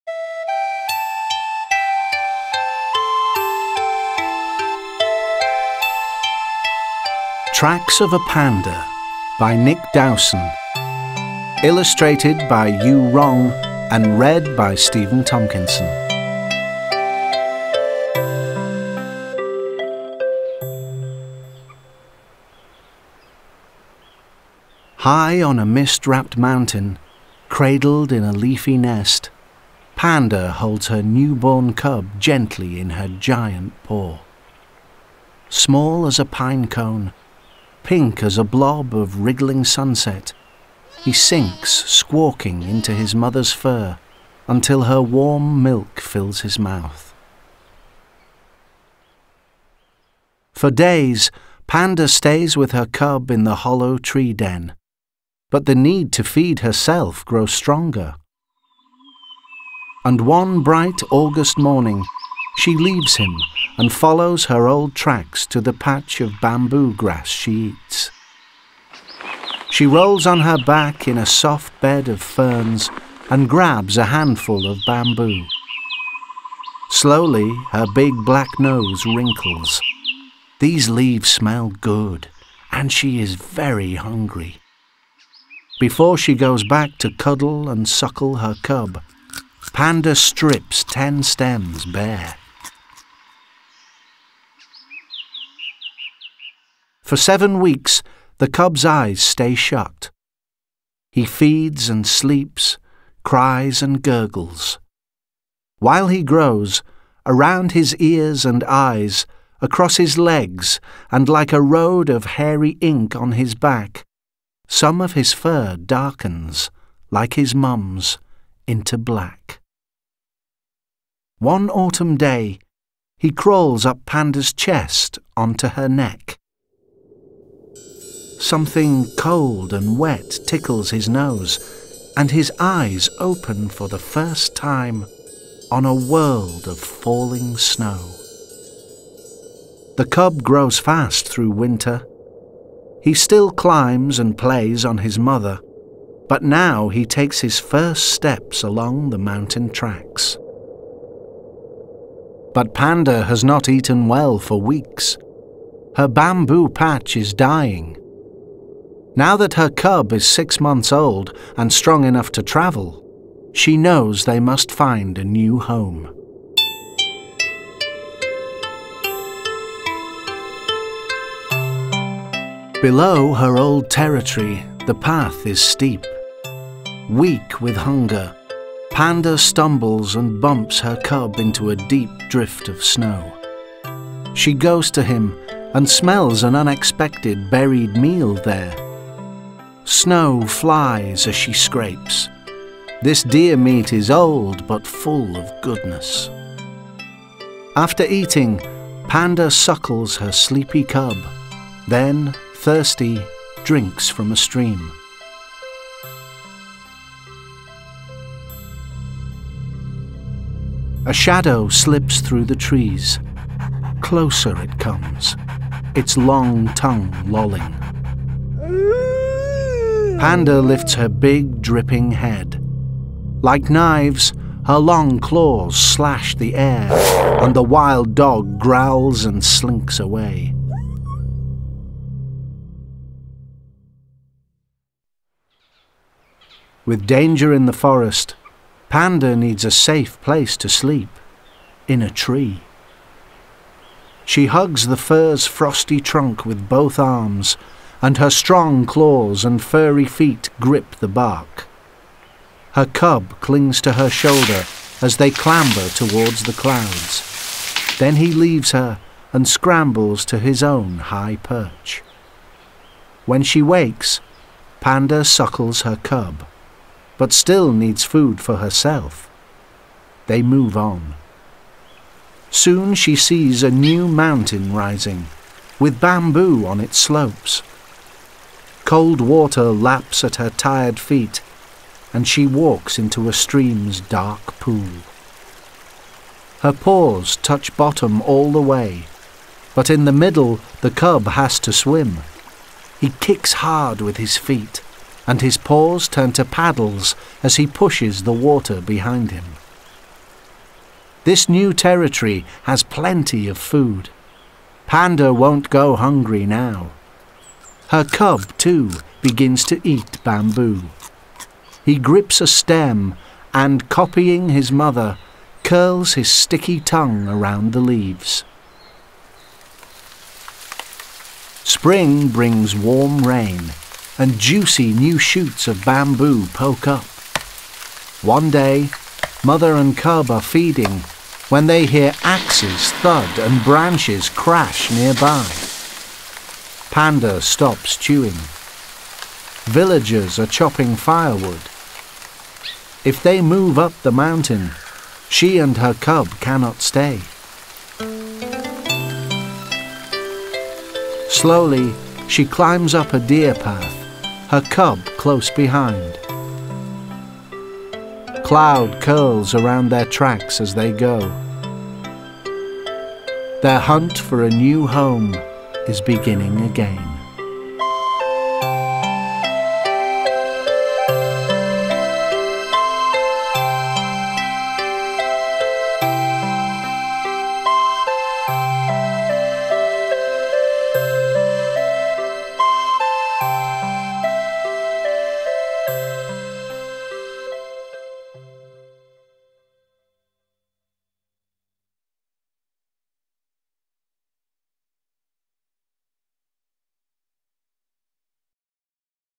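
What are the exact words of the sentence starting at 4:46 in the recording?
Her paws touch bottom all the way, but in the middle the cub has to swim.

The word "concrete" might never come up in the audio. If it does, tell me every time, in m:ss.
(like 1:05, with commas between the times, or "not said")
not said.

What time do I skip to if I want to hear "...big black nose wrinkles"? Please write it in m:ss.
1:17.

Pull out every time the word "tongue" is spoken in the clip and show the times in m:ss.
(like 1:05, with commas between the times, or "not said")
3:36, 5:16.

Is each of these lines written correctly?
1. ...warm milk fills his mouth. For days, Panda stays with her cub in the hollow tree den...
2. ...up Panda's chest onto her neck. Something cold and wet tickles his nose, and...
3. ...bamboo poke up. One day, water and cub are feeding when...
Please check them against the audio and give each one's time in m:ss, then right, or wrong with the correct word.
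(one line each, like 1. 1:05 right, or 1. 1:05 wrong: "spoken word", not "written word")
1. 0:45 right
2. 2:03 right
3. 5:25 wrong: "mother", not "water".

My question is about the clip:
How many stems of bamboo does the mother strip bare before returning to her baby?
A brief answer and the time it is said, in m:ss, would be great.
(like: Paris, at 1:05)
10, at 1:30.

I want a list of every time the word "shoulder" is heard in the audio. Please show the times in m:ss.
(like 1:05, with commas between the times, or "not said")
4:14.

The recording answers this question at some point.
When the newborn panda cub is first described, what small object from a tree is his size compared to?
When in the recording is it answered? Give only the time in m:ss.
0:36.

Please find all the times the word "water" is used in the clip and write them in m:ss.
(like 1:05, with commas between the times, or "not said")
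4:39, 4:58.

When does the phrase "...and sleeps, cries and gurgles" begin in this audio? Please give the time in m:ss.
1:41.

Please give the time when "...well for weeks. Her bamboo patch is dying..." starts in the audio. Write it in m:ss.
2:34.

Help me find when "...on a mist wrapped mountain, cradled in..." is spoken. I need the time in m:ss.
0:25.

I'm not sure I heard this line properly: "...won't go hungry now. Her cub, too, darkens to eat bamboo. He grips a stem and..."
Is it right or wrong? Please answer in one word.
wrong.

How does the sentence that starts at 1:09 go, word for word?
She rolls on her back in a soft bed of ferns and grabs a handful of bamboo.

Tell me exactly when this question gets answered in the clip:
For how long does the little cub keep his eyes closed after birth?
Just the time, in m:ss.
1:37.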